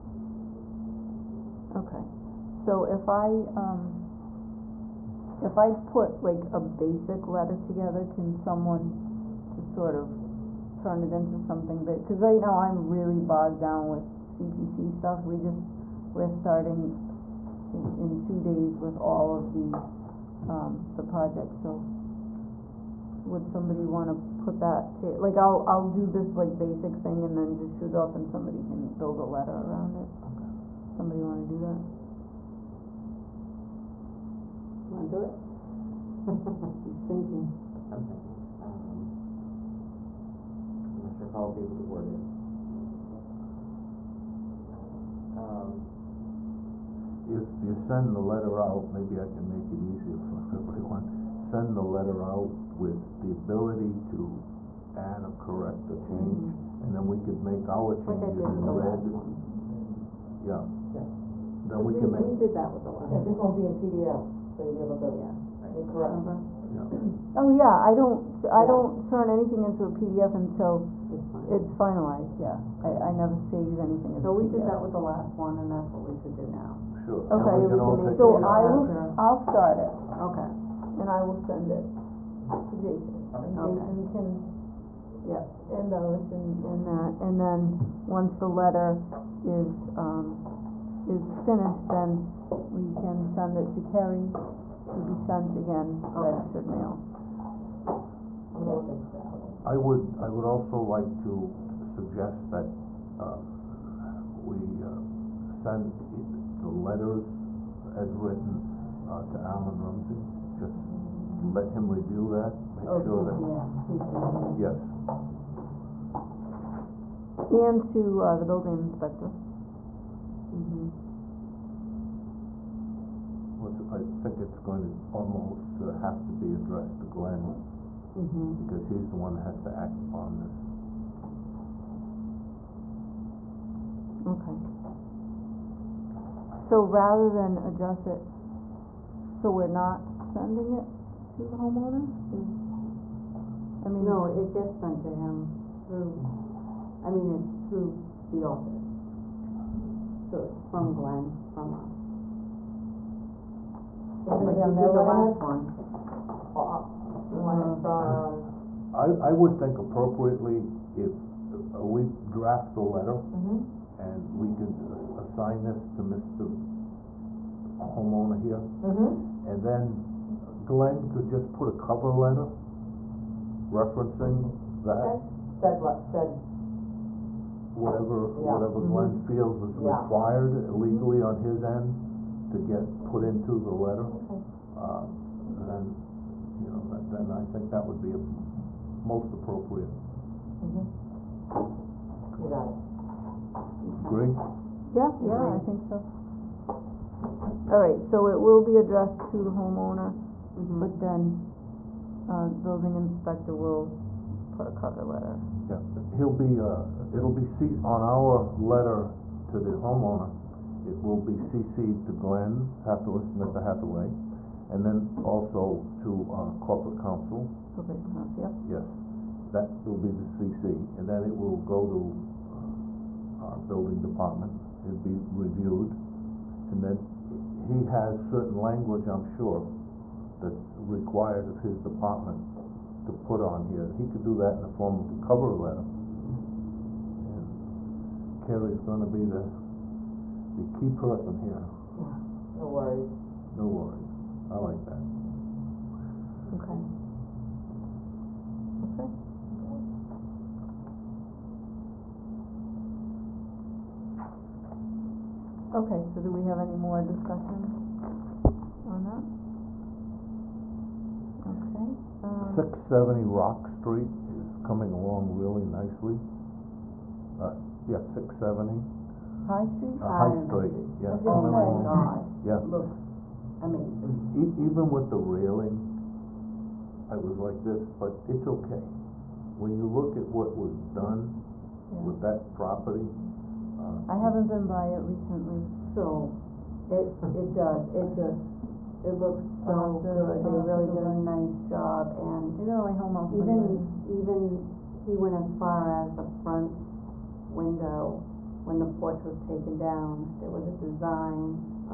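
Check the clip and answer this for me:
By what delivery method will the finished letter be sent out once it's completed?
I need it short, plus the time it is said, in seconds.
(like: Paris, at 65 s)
Registered mail, at 96 s.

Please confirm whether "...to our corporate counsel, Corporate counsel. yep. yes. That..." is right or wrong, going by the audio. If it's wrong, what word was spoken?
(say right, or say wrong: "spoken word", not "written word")
right.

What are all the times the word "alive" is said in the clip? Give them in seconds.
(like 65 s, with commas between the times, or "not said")
not said.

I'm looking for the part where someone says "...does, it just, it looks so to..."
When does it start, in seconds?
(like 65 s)
287 s.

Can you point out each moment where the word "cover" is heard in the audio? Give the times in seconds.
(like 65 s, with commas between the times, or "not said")
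171 s, 204 s, 235 s.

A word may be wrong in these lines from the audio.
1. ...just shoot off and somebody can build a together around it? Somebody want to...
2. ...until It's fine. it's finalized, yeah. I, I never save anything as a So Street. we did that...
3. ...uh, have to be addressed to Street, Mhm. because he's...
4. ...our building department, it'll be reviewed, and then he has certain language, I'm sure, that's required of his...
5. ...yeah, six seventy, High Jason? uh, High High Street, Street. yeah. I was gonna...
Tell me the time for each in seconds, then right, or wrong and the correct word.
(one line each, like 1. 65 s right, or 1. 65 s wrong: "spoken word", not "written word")
1. 27 s wrong: "letter", not "together"
2. 70 s wrong: "PDF", not "Street"
3. 125 s wrong: "Glenn", not "Street"
4. 223 s right
5. 267 s wrong: "Street", not "Jason".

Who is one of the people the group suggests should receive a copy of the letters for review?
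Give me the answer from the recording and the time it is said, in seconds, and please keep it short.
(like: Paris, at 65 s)
Alan Rumsey, at 109 s.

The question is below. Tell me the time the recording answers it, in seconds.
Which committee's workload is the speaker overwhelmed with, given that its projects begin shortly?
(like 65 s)
14 s.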